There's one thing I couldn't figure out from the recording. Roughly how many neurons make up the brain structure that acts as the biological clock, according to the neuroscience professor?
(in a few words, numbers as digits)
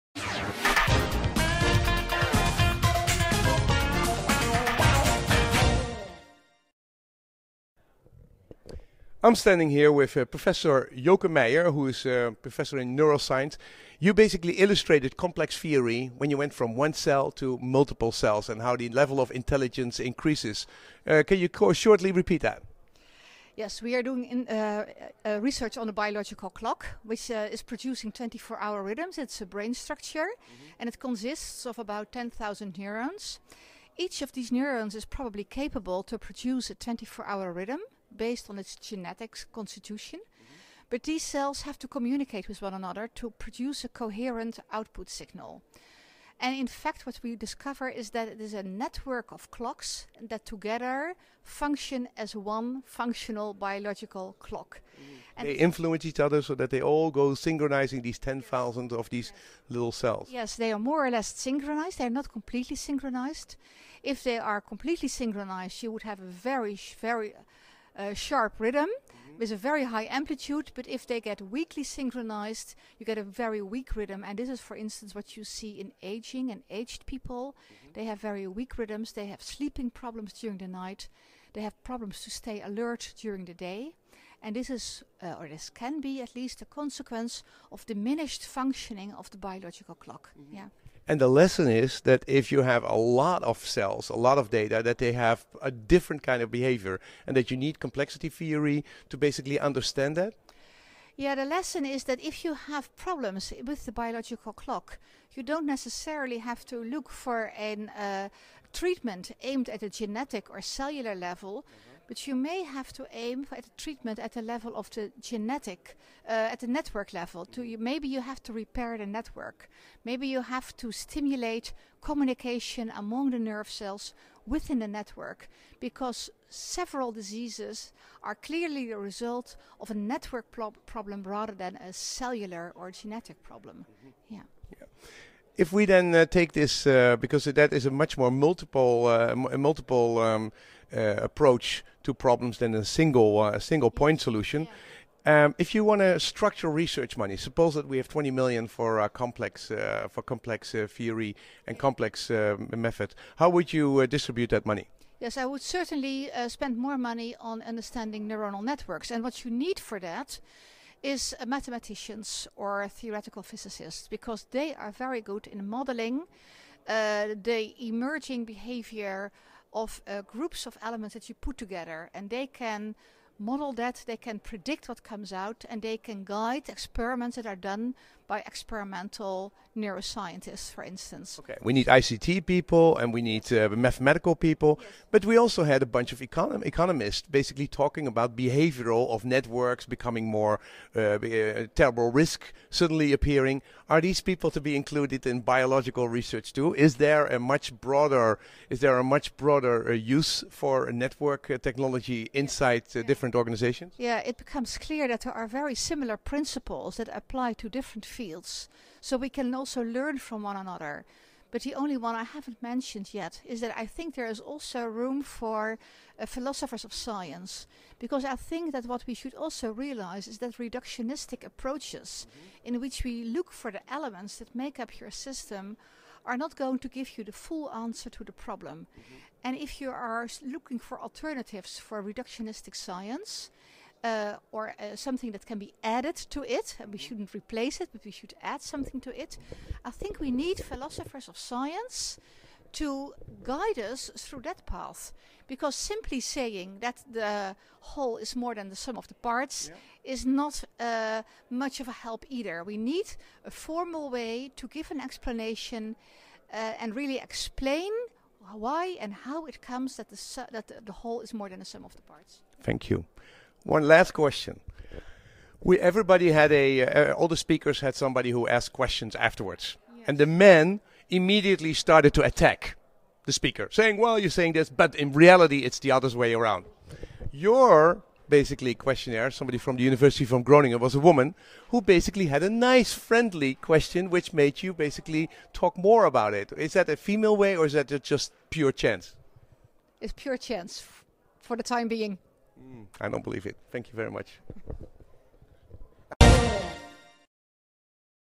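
10,000.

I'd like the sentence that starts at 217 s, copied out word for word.
Because I think that what we should also realize is that reductionistic approaches, mm-hmm.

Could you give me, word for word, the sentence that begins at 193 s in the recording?
Are these people to be included in biological research too?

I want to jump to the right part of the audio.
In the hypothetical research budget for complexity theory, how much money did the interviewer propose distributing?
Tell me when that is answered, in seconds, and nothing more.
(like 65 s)
148 s.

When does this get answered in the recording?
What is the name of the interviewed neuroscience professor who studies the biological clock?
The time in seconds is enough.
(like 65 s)
10 s.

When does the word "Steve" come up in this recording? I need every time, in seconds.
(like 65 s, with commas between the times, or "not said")
not said.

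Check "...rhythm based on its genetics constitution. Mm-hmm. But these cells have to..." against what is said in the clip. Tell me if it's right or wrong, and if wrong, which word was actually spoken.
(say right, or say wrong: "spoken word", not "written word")
right.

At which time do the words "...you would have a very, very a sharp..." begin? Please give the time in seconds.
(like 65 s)
65 s.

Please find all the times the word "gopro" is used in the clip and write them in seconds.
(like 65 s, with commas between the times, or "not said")
not said.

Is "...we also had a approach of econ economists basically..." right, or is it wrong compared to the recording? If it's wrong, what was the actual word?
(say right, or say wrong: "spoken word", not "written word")
wrong: "bunch", not "approach".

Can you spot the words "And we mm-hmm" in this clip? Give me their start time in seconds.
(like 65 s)
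236 s.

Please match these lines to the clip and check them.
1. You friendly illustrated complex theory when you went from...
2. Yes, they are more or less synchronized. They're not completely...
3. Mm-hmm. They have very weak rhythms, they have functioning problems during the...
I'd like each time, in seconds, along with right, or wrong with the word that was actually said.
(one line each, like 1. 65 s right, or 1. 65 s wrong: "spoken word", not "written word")
1. 13 s wrong: "basically", not "friendly"
2. 60 s right
3. 77 s wrong: "sleeping", not "functioning".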